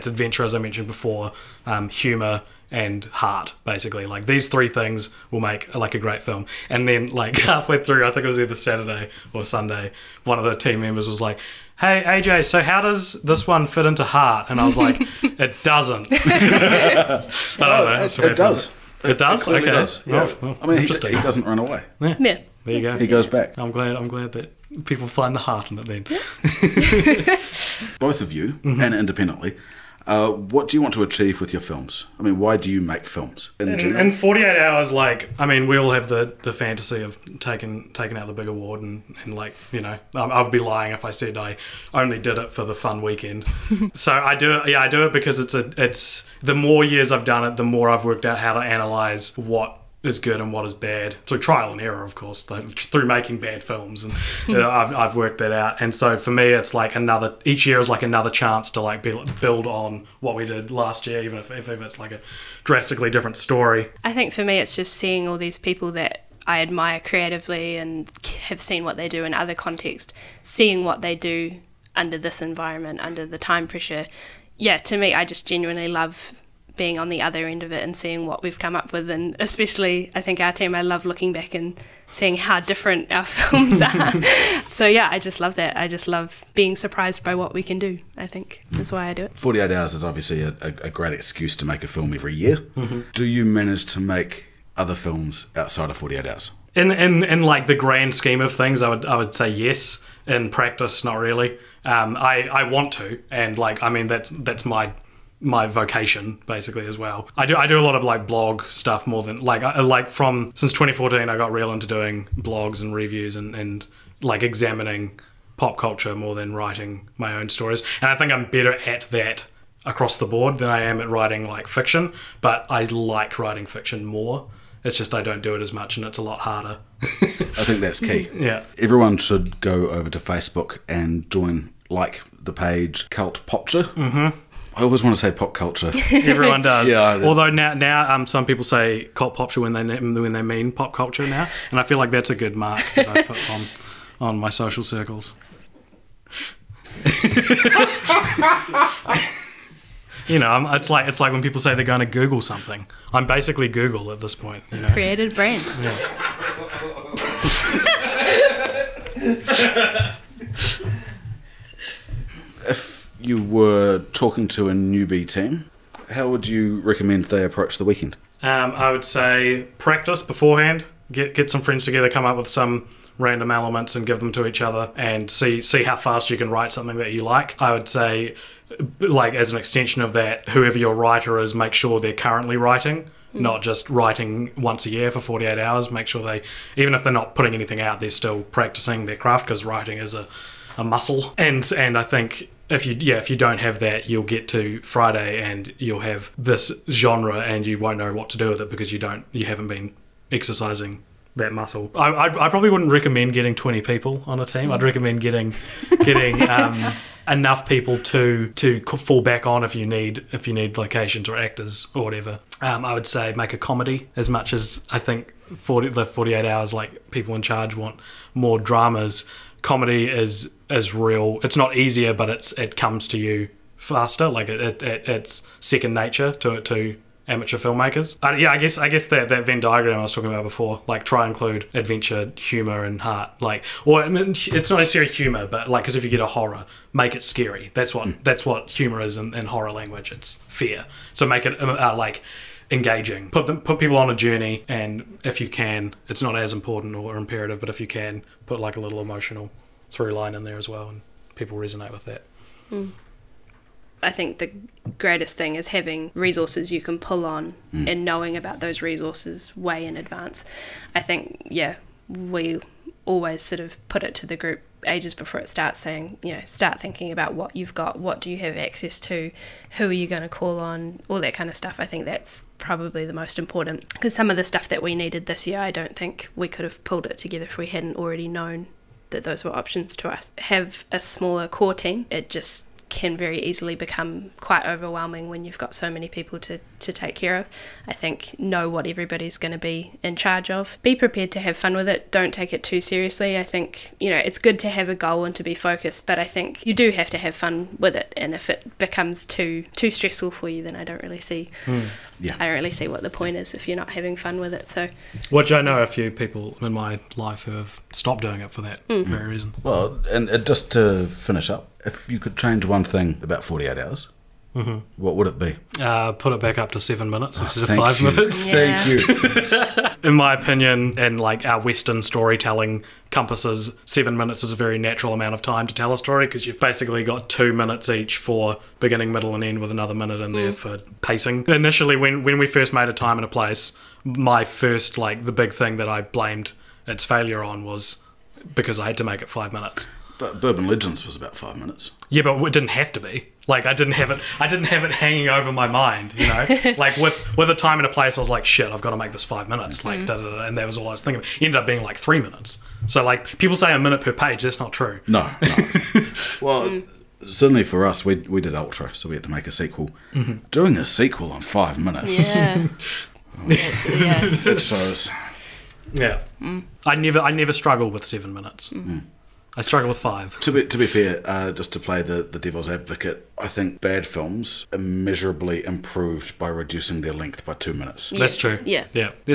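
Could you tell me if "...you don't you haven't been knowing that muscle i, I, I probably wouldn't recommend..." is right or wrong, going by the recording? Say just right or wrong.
wrong.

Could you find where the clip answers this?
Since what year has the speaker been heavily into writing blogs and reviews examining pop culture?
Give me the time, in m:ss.
1:50.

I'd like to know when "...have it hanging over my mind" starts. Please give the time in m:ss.
5:44.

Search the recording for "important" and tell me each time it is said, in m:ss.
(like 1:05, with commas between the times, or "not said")
4:06, 4:33.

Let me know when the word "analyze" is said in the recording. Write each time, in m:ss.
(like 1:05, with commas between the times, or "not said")
0:48.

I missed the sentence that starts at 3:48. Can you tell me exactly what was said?
Uh, yeah, I guess I guess that, that Venn diagram I was talking about before, like try include adventure, humor, and heart.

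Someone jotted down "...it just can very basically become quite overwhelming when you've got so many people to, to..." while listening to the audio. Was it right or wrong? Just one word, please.
wrong.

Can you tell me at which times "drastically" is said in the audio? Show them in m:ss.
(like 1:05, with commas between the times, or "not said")
1:02.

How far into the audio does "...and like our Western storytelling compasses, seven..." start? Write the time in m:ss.
5:20.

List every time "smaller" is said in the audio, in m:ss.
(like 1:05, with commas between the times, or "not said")
4:40.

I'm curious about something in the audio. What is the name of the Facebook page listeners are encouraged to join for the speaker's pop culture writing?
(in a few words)
Cult Popture.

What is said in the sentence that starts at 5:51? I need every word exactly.
It ended up being like three minutes.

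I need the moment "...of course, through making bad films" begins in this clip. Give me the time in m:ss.
0:52.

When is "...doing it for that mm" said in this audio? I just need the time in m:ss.
5:08.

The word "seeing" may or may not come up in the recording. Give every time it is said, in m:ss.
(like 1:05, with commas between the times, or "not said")
1:04, 1:10, 1:17, 1:22.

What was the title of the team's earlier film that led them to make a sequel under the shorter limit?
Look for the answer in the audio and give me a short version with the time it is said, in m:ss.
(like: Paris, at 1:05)
Ultra, at 5:58.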